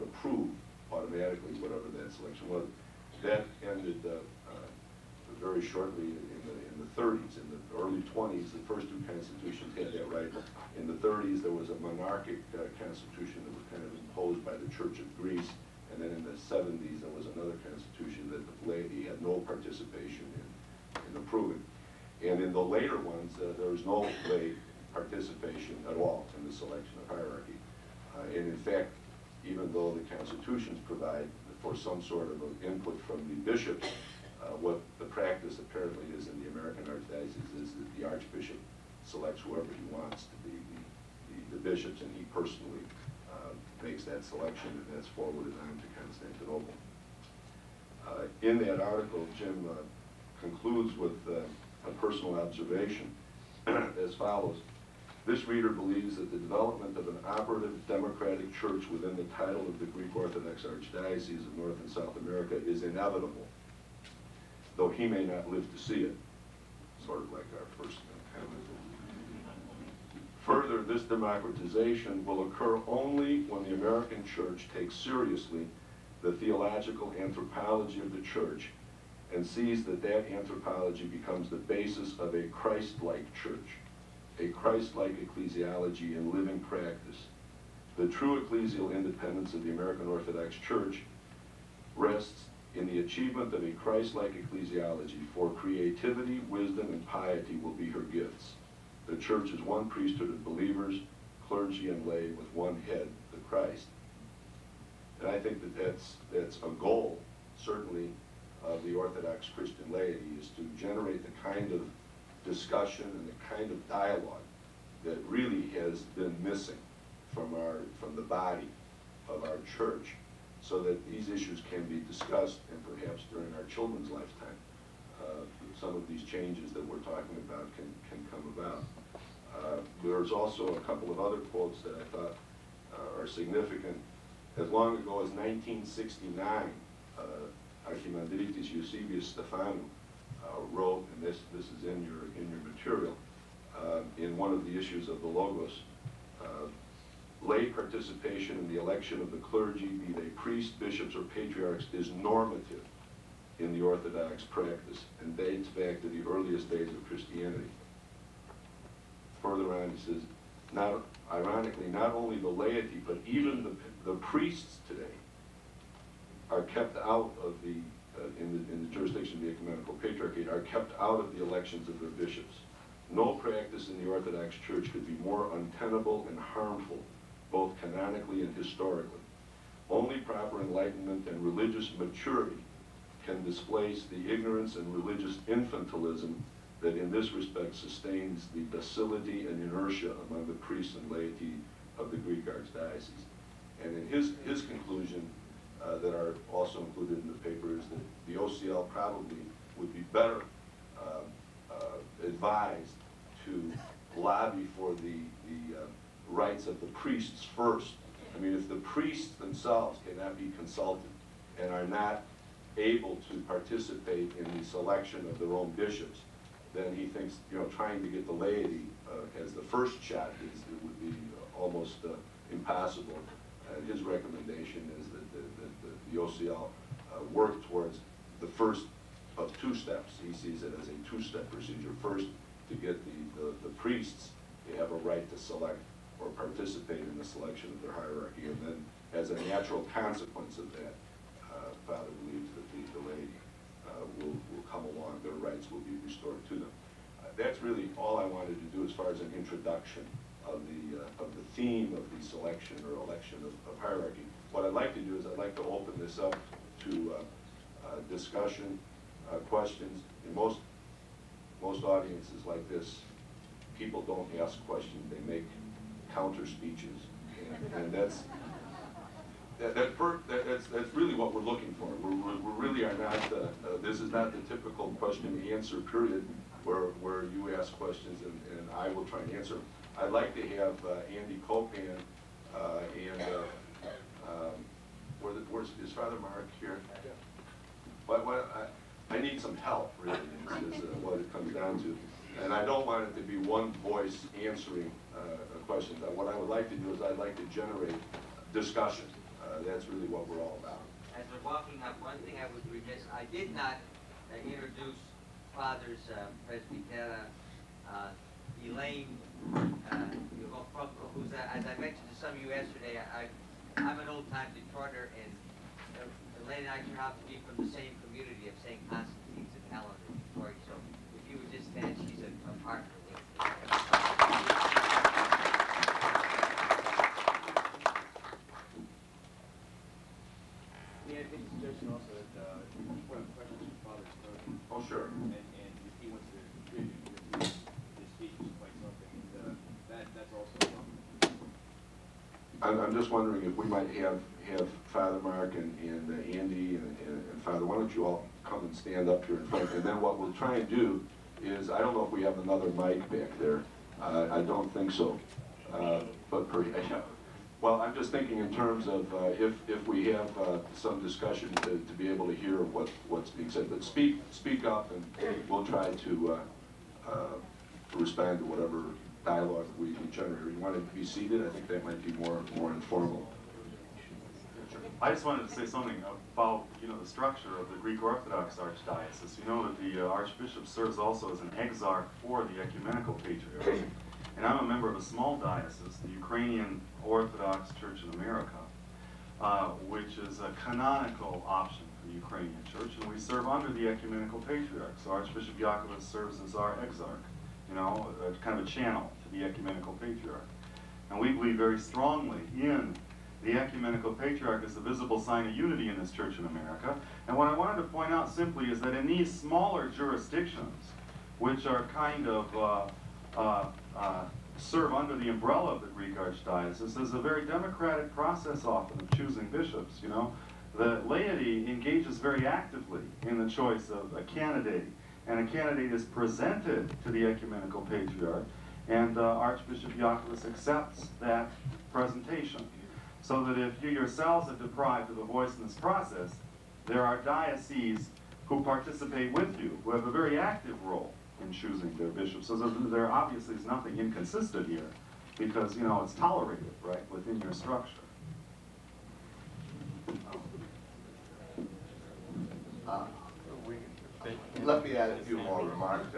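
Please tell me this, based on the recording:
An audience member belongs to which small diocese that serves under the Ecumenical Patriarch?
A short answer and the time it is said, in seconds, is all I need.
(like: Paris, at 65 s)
Ukrainian Orthodox Church in America, at 386 s.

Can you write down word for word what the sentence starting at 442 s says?
So there obviously is nothing inconsistent here because, you know, it's tolerated, right, within your structure.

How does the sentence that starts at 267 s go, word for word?
And, and that's, that, that per, that, that's, that's really what we're looking for.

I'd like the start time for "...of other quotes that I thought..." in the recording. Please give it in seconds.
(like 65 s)
131 s.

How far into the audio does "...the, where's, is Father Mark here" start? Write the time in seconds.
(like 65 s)
285 s.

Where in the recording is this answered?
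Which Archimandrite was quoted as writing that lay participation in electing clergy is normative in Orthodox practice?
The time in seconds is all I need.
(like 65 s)
138 s.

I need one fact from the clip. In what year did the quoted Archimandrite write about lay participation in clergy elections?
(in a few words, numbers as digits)
1969.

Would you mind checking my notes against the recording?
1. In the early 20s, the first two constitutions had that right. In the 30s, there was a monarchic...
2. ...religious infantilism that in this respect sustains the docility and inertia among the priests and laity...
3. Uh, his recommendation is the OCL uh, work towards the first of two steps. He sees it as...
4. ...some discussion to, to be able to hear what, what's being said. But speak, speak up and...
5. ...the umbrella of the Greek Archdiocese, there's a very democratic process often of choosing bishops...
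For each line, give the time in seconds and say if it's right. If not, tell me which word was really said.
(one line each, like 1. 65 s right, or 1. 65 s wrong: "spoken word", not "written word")
1. 7 s right
2. 184 s right
3. 223 s right
4. 360 s right
5. 415 s right.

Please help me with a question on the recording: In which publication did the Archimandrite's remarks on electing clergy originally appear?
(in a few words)
the Logos.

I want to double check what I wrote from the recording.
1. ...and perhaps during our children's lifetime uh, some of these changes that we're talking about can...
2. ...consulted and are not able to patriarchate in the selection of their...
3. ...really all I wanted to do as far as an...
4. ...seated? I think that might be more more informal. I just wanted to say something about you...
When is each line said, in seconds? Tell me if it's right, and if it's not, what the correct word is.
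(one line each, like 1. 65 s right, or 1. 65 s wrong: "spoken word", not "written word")
1. 122 s right
2. 210 s wrong: "participate", not "patriarchate"
3. 247 s right
4. 371 s right.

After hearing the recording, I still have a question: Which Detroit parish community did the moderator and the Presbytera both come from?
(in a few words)
St. Constantine's and Helen.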